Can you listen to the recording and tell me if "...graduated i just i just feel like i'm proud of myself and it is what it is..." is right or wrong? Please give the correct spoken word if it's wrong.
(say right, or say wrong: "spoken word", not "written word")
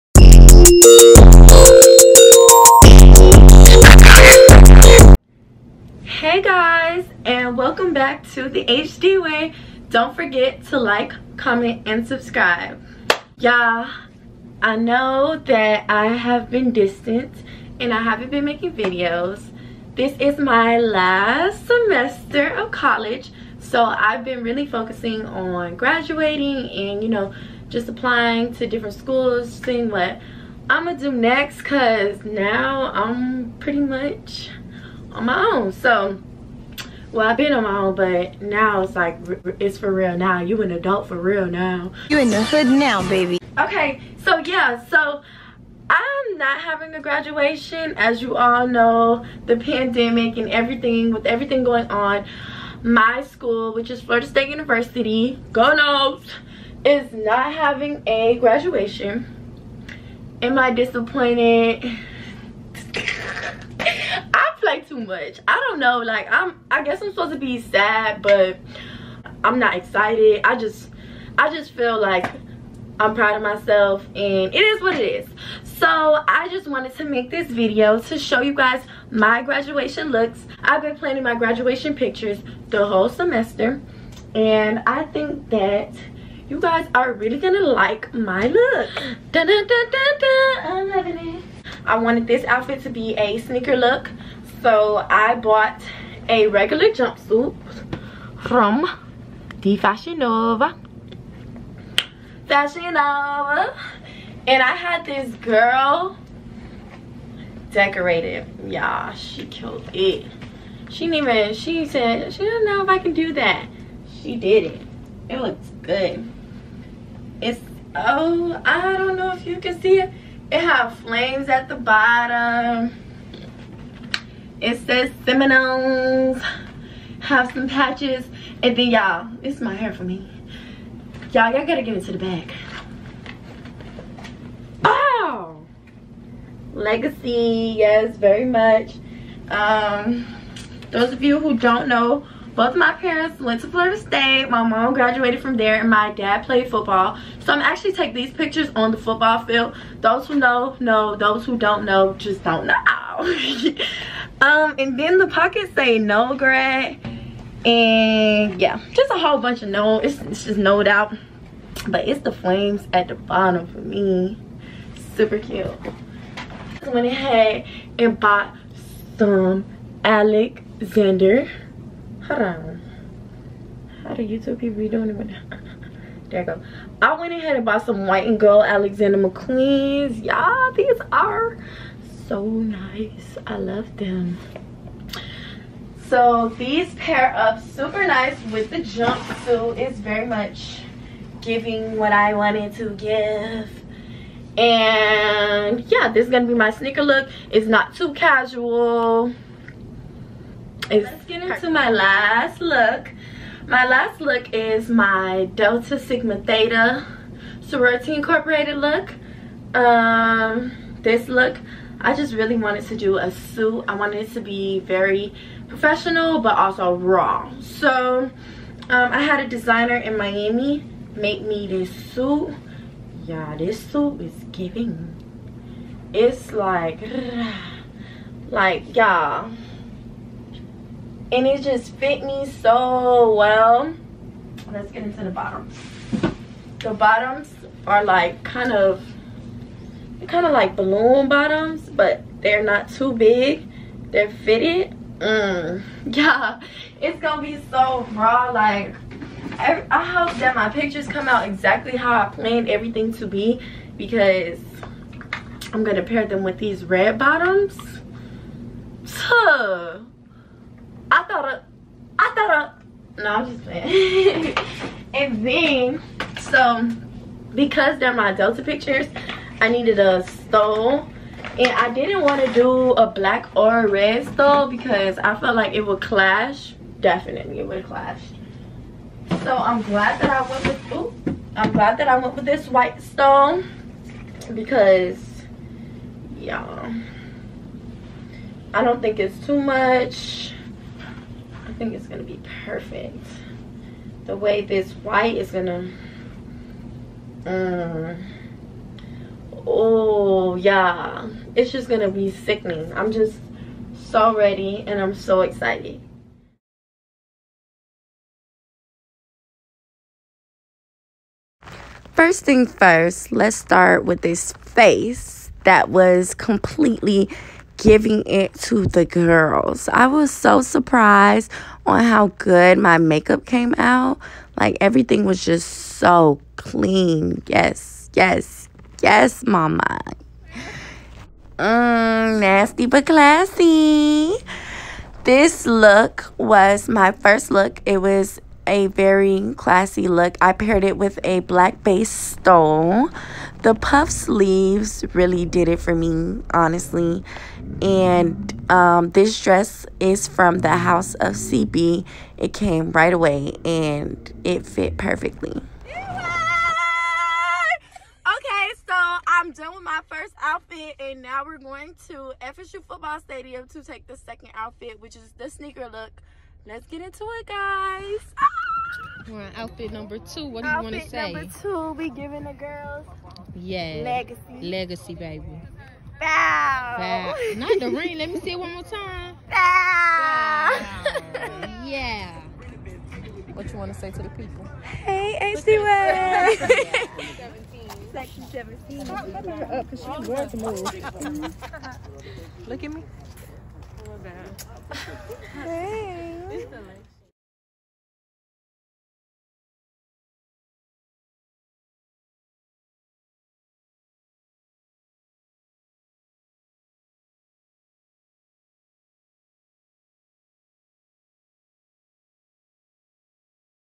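wrong: "excited", not "graduated".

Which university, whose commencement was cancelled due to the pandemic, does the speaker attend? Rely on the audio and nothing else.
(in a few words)
Florida State University.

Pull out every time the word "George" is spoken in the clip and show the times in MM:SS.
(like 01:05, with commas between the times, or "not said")
not said.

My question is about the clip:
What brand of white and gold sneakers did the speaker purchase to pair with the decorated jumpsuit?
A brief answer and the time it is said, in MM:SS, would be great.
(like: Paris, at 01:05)
Alexander McQueen, at 02:58.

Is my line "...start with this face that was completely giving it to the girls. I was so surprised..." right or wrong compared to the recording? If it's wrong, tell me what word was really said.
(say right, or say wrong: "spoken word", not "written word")
right.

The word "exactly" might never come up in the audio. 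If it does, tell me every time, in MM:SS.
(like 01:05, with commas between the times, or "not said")
04:11.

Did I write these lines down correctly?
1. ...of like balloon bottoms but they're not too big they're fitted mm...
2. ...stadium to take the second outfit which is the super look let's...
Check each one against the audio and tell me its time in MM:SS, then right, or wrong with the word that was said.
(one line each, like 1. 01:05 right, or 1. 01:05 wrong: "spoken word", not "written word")
1. 04:00 right
2. 06:03 wrong: "sneaker", not "super".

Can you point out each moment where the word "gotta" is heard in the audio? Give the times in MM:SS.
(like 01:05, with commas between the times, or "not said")
02:11.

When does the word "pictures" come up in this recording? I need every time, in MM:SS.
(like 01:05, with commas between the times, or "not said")
01:21, 02:28, 04:10, 04:28.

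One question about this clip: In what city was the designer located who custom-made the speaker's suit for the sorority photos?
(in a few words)
Miami.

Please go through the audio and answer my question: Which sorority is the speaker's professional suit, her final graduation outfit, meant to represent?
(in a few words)
Delta Sigma Theta.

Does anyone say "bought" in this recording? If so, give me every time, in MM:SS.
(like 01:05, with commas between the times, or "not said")
01:35, 02:48, 02:57.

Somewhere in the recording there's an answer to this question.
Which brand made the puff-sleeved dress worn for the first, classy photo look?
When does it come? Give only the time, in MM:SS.
05:50.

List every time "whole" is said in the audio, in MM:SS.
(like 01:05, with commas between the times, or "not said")
01:22, 02:39.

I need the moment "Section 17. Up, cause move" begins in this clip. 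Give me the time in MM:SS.
06:28.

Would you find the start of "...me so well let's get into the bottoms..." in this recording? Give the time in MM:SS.
03:52.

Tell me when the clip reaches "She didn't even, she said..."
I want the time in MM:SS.
01:50.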